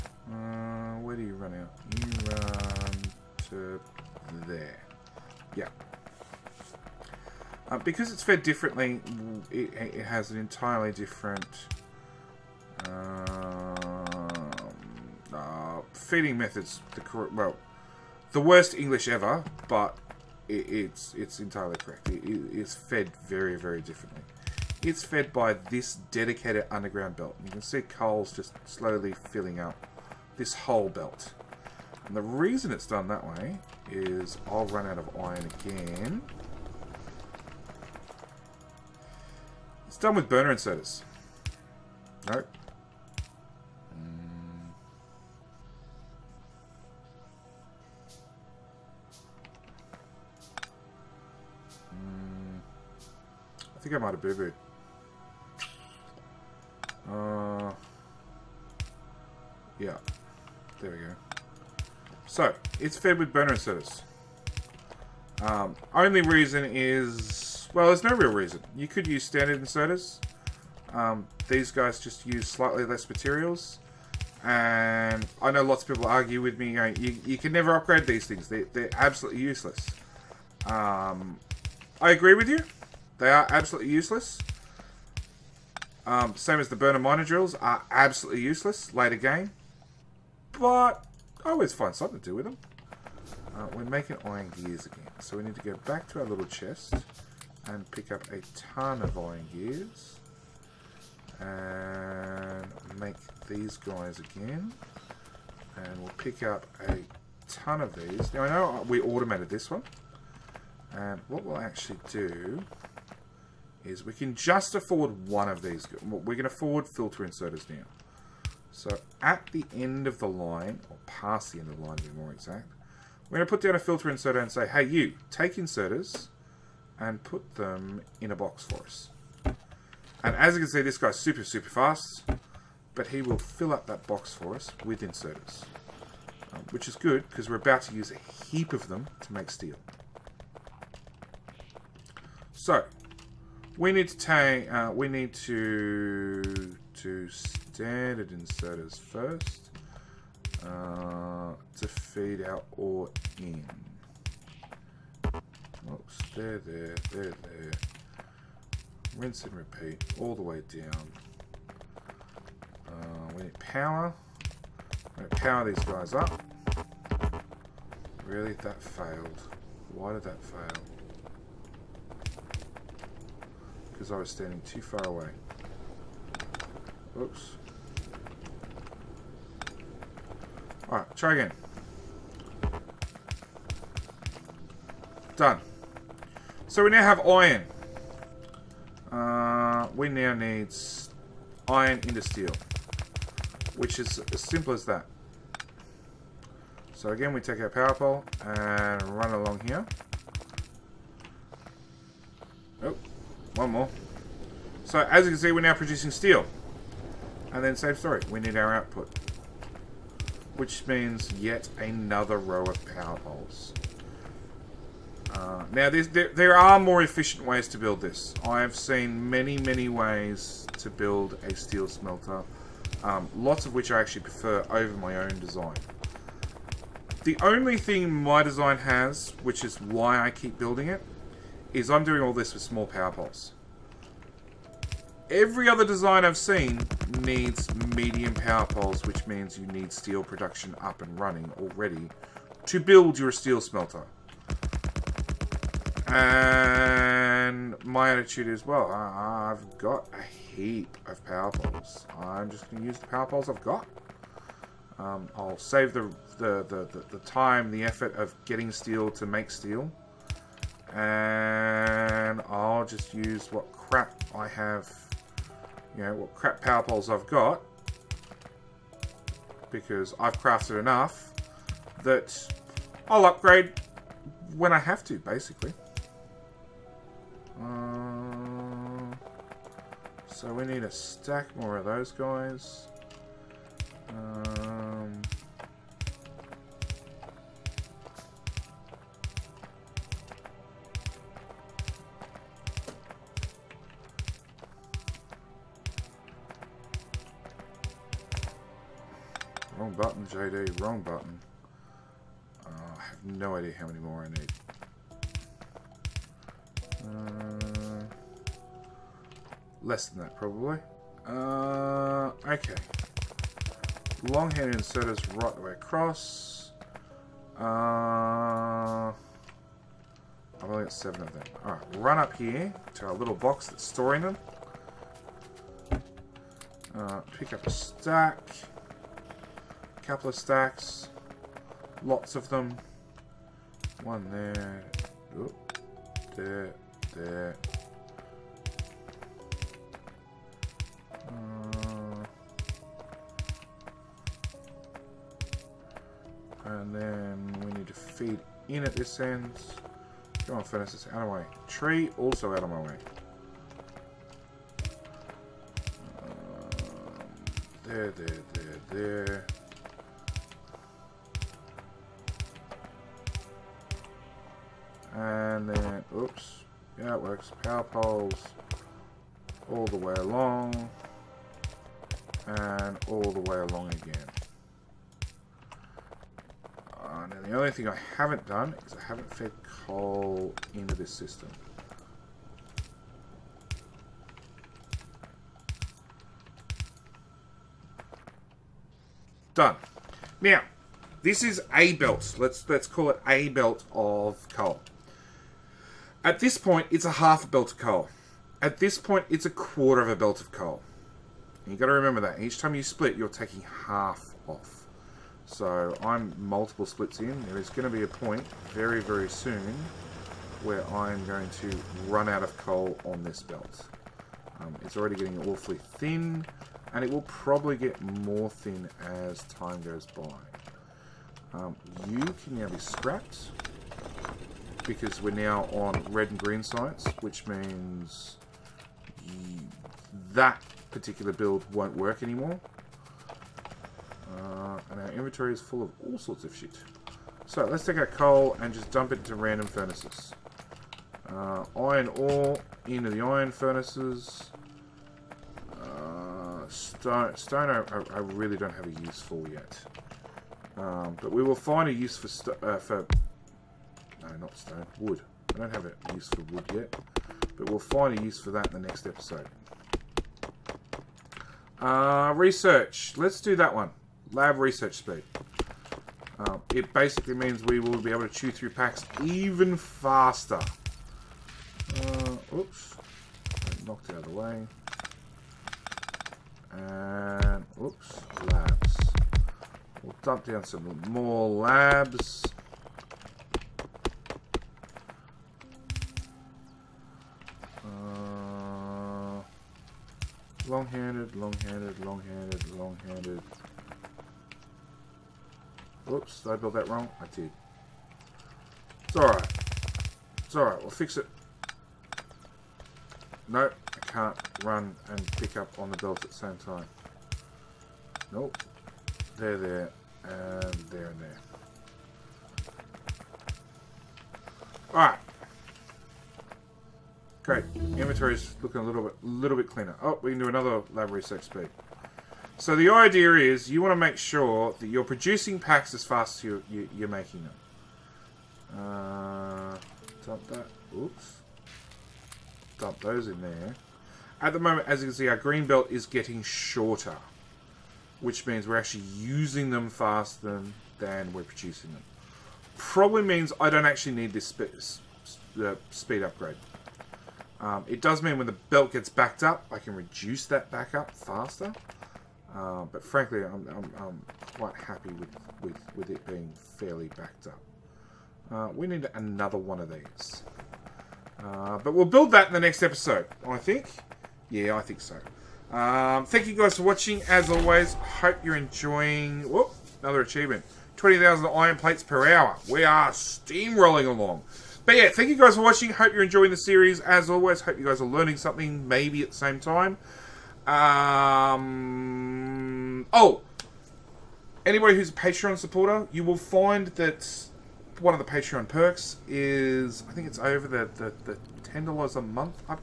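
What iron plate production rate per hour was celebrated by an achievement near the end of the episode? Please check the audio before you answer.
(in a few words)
20,000.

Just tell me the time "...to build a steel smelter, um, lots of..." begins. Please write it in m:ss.
3:40.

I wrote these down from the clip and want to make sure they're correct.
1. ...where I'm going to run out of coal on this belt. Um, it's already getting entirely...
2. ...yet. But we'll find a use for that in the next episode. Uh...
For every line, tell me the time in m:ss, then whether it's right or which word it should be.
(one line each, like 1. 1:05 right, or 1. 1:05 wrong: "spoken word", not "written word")
1. 6:50 wrong: "awfully", not "entirely"
2. 7:36 right.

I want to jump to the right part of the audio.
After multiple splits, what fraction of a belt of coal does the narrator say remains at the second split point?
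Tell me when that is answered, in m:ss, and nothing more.
6:39.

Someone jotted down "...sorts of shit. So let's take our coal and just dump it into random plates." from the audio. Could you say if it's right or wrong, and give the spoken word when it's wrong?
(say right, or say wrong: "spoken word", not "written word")
wrong: "furnaces", not "plates".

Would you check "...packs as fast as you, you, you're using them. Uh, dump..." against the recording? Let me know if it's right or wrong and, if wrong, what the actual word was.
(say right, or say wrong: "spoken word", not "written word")
wrong: "making", not "using".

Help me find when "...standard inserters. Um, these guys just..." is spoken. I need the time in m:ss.
1:09.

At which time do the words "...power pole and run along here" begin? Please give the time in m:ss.
3:17.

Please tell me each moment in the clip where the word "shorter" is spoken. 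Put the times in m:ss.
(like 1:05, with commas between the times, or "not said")
8:56.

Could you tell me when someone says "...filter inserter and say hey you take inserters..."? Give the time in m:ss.
2:03.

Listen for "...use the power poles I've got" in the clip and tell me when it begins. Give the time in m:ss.
4:12.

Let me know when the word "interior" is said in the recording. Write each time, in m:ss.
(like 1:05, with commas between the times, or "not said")
not said.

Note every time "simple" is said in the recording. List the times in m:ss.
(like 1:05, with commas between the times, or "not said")
3:14.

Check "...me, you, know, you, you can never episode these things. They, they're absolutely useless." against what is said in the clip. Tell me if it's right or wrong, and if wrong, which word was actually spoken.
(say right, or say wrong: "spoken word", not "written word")
wrong: "upgrade", not "episode".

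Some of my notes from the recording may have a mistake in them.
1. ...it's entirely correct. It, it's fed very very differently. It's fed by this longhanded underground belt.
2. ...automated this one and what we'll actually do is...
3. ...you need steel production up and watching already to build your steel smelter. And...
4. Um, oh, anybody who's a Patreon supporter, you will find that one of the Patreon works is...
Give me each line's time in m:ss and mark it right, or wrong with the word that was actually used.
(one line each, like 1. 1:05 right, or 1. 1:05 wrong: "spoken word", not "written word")
1. 0:21 wrong: "dedicated", not "longhanded"
2. 1:49 right
3. 3:59 wrong: "running", not "watching"
4. 9:40 wrong: "perks", not "works".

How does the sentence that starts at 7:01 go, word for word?
Um, you can now be scrapped because we're now on red and green science, which means that particular build won't work anymore.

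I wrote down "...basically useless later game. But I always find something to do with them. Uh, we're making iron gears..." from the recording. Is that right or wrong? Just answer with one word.
wrong.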